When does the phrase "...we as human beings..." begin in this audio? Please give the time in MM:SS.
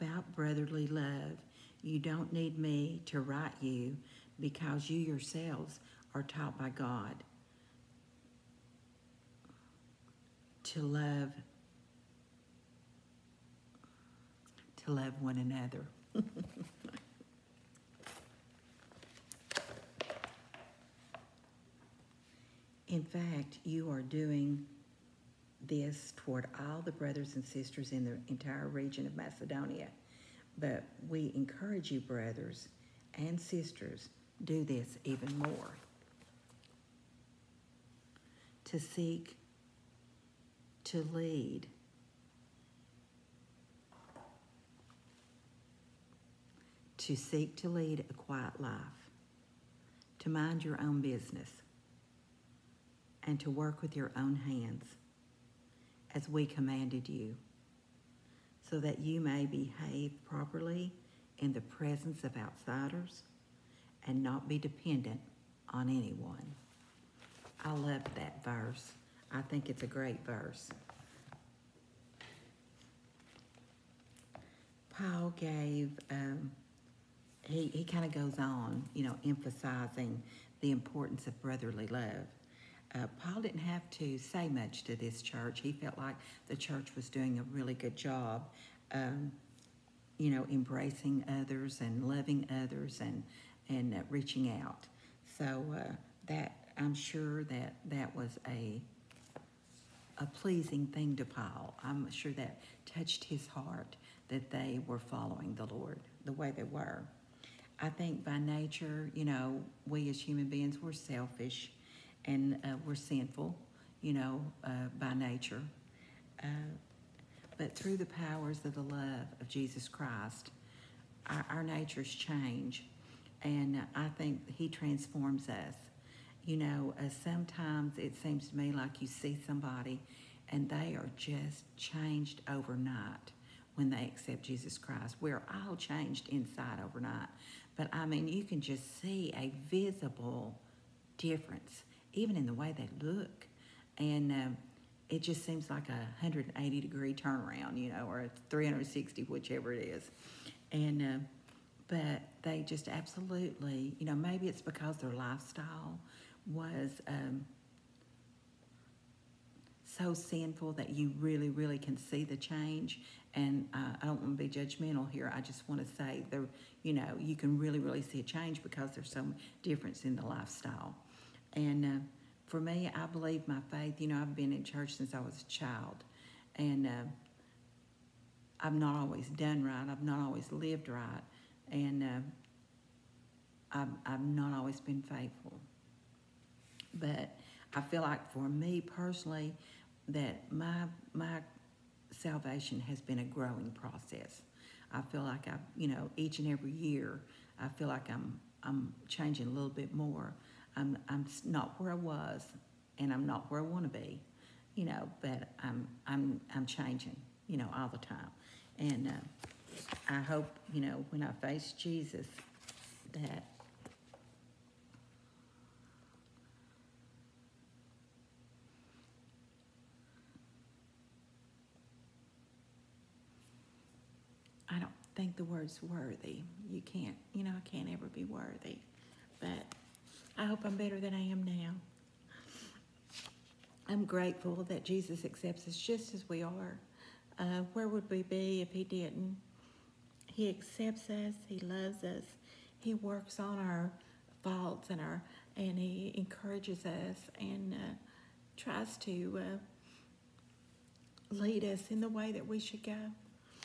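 01:49.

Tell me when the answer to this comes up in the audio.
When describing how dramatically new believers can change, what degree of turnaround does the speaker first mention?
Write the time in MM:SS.
02:25.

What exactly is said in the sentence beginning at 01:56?
Uh, but through the powers of the love of Jesus Christ, our, our natures change.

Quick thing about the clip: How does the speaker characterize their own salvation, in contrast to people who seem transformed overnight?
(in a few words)
a growing process.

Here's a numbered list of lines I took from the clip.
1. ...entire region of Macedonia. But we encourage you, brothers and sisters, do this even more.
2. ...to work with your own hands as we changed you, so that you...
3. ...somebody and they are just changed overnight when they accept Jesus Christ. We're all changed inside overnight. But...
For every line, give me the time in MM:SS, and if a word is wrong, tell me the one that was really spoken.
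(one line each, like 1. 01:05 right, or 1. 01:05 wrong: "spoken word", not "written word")
1. 00:28 right
2. 00:53 wrong: "commanded", not "changed"
3. 02:09 right.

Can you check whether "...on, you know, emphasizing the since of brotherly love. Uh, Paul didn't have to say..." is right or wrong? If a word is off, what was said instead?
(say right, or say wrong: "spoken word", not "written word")
wrong: "importance", not "since".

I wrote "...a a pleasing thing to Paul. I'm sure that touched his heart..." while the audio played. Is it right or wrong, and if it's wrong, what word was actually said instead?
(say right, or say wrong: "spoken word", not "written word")
right.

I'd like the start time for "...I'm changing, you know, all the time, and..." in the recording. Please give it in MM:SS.
03:26.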